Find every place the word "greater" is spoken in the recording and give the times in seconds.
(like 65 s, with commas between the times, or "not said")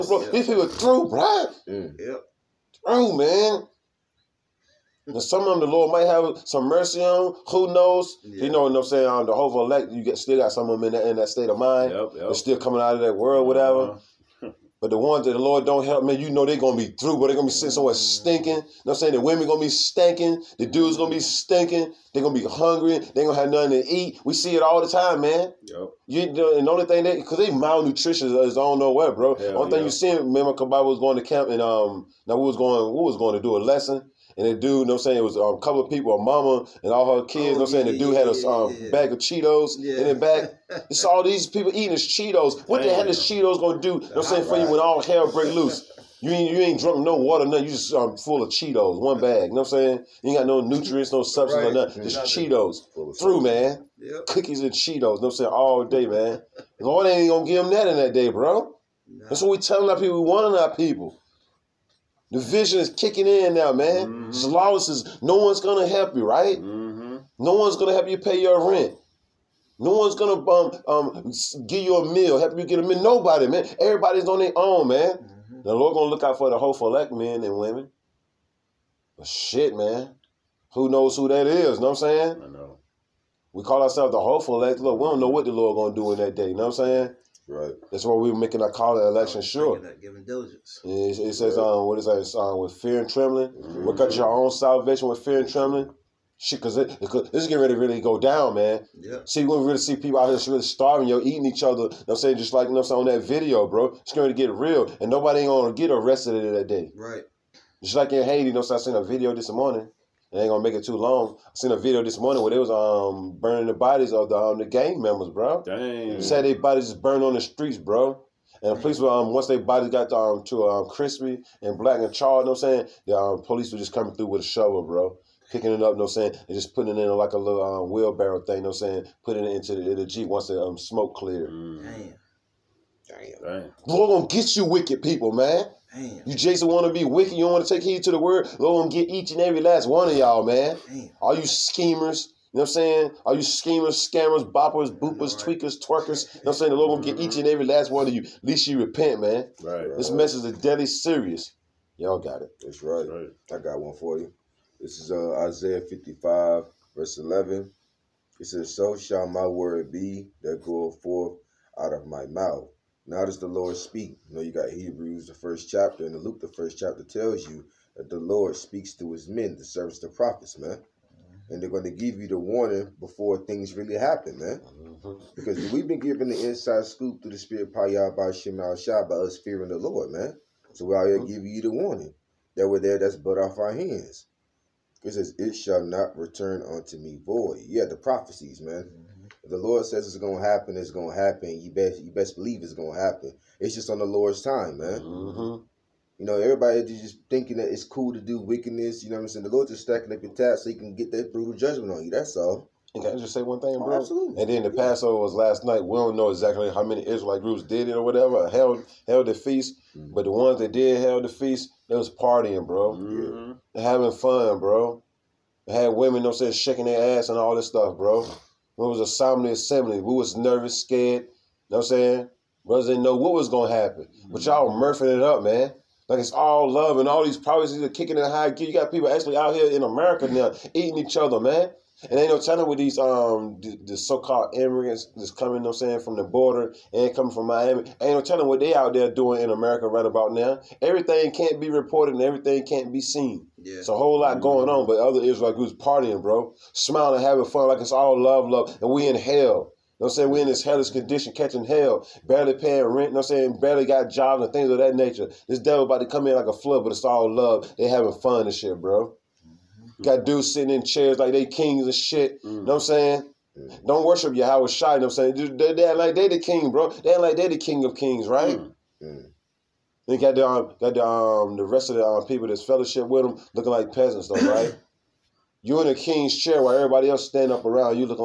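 not said.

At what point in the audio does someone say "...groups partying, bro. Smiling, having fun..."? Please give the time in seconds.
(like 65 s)
245 s.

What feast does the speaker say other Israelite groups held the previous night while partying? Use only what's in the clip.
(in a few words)
Passover.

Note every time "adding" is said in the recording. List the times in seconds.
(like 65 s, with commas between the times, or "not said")
not said.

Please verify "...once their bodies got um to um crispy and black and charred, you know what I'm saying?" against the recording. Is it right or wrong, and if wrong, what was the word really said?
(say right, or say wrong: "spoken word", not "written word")
right.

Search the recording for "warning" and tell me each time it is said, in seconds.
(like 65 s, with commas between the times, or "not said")
60 s, 172 s, 181 s.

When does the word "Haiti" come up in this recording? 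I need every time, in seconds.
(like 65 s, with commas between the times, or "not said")
108 s.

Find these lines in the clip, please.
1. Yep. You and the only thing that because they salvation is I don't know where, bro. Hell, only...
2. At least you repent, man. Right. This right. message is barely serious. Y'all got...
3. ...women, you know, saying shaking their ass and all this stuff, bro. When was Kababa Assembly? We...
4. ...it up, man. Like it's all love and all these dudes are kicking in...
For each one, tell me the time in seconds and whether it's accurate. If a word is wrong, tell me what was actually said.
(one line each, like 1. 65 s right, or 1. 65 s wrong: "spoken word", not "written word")
1. 25 s wrong: "malnutrition", not "salvation"
2. 148 s wrong: "deadly", not "barely"
3. 215 s wrong: "Assembly", not "Kababa"
4. 225 s wrong: "properties", not "dudes".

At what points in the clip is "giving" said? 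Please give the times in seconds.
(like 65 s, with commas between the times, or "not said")
90 s, 181 s.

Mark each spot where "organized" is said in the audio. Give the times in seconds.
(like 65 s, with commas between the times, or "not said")
not said.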